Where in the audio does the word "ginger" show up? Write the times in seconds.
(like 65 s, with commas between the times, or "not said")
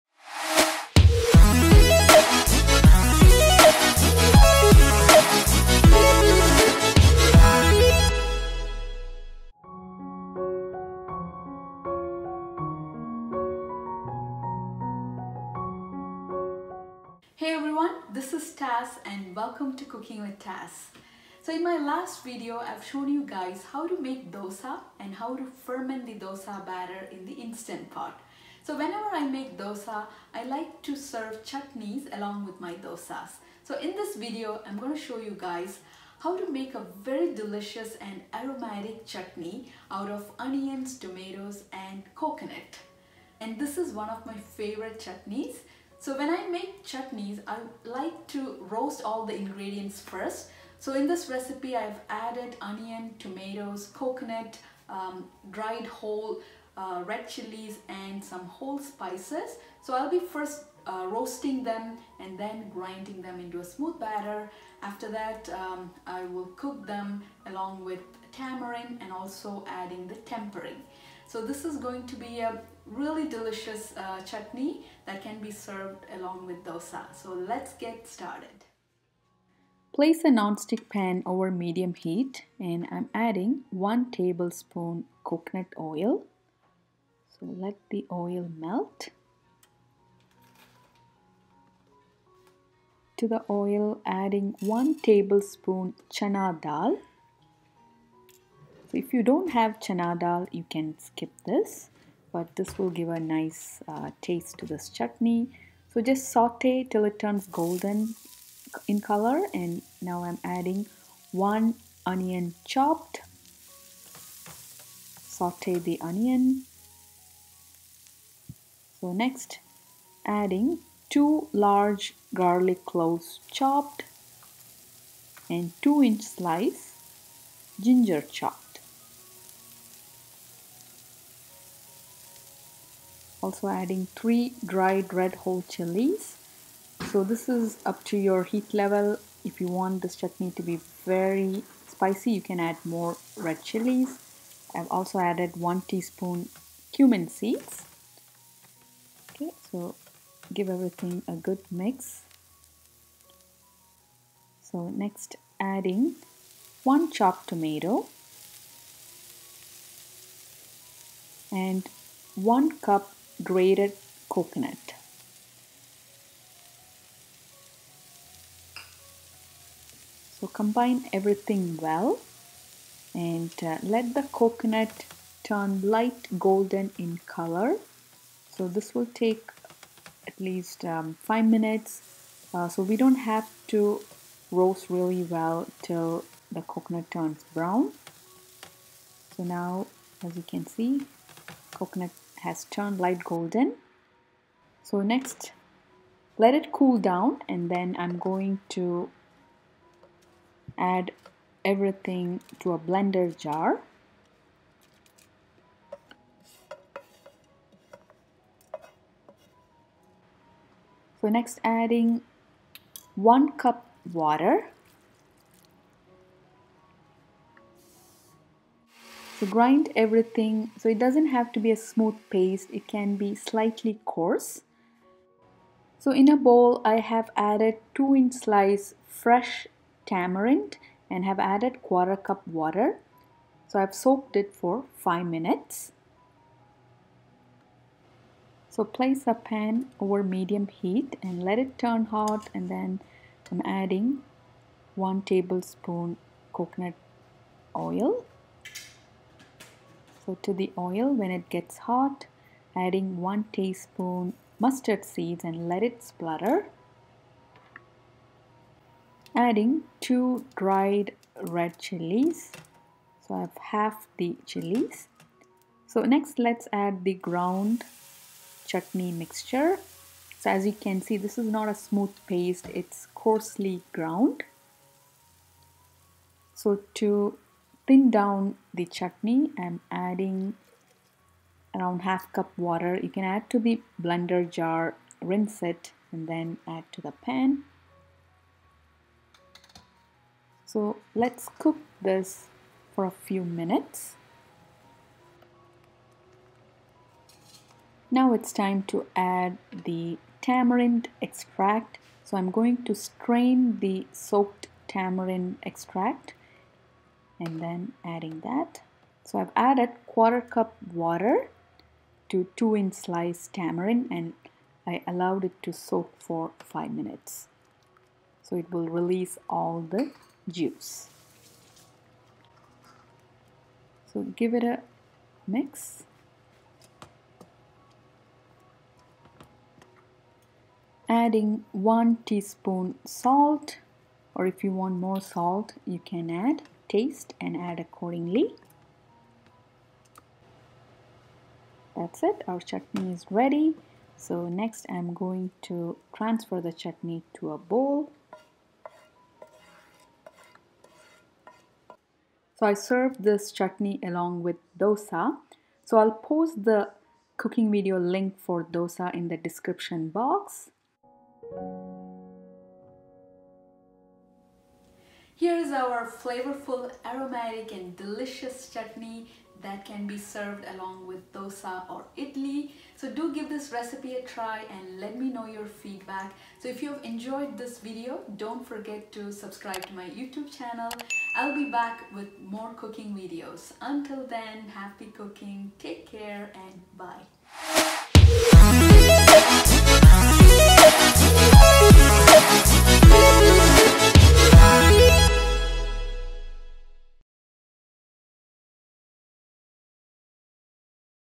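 127 s.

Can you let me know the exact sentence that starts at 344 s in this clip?
So next I'm going to transfer the chutney to a bowl.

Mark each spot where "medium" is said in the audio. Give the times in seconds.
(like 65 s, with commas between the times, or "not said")
81 s, 240 s.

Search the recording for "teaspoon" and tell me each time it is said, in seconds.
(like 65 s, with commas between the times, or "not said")
145 s, 253 s, 332 s.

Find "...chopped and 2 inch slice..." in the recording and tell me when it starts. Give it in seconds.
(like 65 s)
123 s.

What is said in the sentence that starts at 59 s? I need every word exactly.
So I'll be first uh, roasting them and then grinding them into a smooth batter.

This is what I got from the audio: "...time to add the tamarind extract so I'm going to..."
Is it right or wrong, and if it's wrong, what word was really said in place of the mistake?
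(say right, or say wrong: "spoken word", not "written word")
right.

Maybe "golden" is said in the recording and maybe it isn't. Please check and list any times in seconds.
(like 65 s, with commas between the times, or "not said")
107 s, 176 s, 193 s.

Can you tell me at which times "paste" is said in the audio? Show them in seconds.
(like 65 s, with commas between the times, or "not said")
222 s, 272 s.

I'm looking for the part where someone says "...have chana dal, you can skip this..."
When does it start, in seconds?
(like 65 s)
99 s.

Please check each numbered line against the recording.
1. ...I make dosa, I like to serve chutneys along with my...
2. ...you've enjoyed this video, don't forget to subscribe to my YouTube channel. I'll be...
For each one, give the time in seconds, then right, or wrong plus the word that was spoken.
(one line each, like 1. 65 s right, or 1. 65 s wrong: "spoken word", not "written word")
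1. 29 s right
2. 376 s right.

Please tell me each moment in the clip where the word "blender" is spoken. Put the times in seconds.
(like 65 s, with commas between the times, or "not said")
202 s, 284 s.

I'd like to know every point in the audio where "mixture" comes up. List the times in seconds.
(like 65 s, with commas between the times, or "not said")
269 s.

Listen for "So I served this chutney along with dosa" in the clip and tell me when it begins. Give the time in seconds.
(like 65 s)
352 s.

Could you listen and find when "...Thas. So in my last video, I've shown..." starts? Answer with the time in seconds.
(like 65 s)
20 s.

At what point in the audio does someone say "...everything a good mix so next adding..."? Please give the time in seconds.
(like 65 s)
150 s.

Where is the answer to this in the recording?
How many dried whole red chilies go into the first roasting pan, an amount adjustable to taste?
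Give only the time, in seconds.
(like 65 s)
134 s.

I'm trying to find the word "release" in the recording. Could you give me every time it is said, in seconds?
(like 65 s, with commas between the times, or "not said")
318 s.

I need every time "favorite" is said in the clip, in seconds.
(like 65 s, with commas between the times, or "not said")
44 s.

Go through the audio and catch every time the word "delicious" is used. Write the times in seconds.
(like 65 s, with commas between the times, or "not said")
37 s, 73 s, 367 s.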